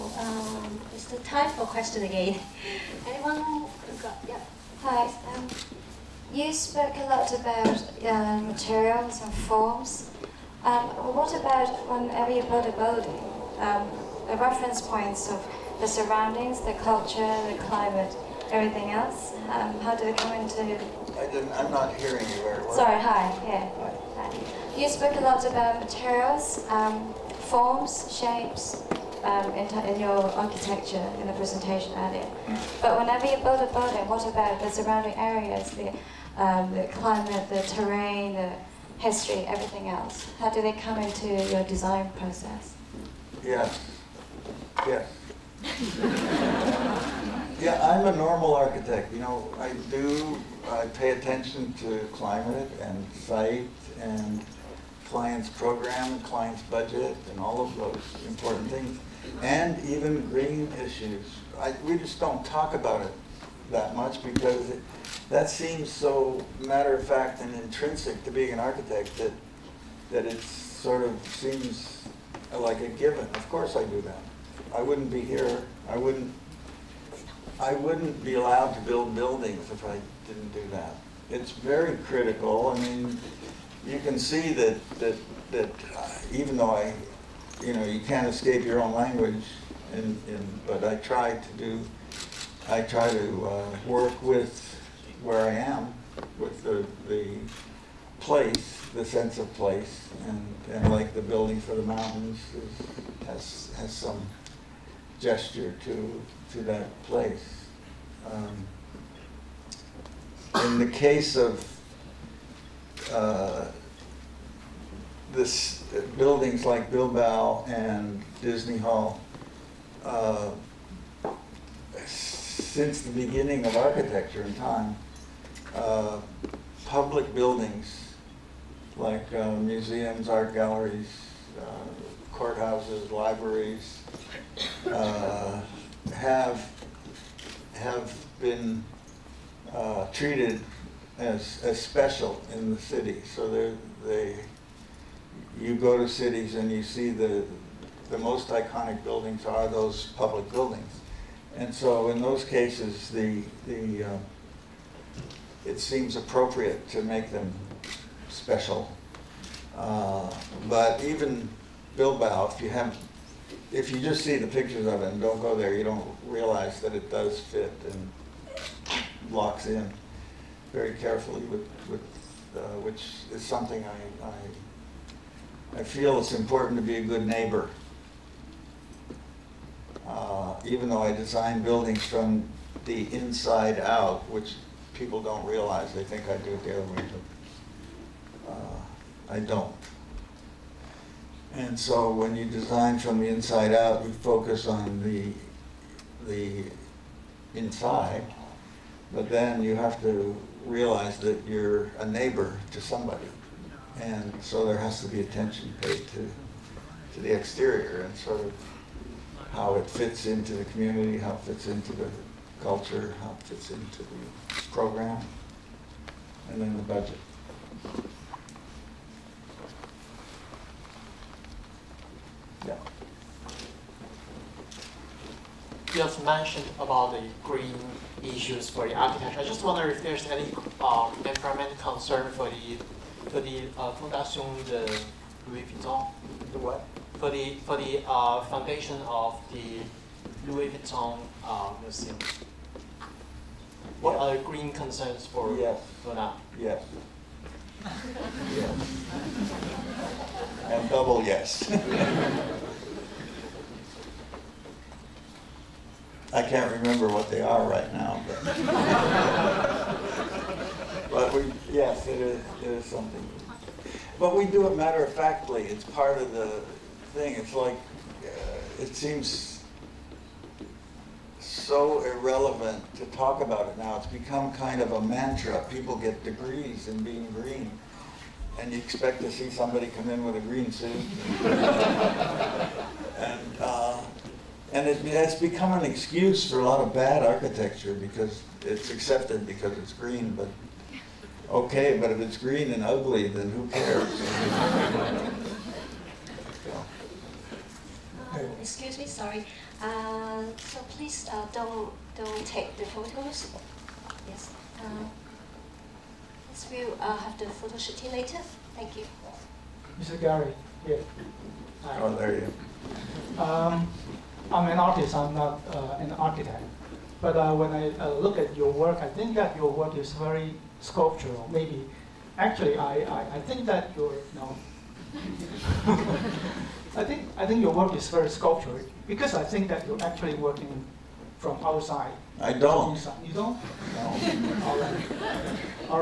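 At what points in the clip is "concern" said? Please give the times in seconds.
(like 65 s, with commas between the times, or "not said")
231 s, 244 s.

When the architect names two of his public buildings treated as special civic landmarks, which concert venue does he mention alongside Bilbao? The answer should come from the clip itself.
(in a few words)
Disney Hall.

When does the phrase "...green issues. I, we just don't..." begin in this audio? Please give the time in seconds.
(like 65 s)
60 s.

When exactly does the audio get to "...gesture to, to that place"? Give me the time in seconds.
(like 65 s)
105 s.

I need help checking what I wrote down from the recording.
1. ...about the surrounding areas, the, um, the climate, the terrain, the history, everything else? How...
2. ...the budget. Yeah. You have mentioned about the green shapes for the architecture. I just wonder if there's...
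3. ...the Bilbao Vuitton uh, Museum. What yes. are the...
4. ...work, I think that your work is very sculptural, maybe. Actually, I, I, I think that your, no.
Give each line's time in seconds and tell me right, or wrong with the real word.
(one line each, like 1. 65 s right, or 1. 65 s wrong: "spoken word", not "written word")
1. 34 s right
2. 216 s wrong: "issues", not "shapes"
3. 239 s wrong: "Louis", not "Bilbao"
4. 318 s right.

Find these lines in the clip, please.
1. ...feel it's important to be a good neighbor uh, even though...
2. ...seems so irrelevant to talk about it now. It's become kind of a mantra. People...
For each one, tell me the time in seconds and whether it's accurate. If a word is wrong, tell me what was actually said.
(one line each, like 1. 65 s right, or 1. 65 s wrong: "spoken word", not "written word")
1. 175 s right
2. 268 s right.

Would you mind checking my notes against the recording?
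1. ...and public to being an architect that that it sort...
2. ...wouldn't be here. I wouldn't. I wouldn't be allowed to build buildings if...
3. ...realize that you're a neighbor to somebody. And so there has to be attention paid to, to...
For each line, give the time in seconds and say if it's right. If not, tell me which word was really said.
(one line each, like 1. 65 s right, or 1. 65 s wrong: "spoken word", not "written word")
1. 67 s wrong: "intrinsic", not "public"
2. 74 s right
3. 200 s right.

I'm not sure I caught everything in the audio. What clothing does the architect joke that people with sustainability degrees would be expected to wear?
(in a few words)
A green suit.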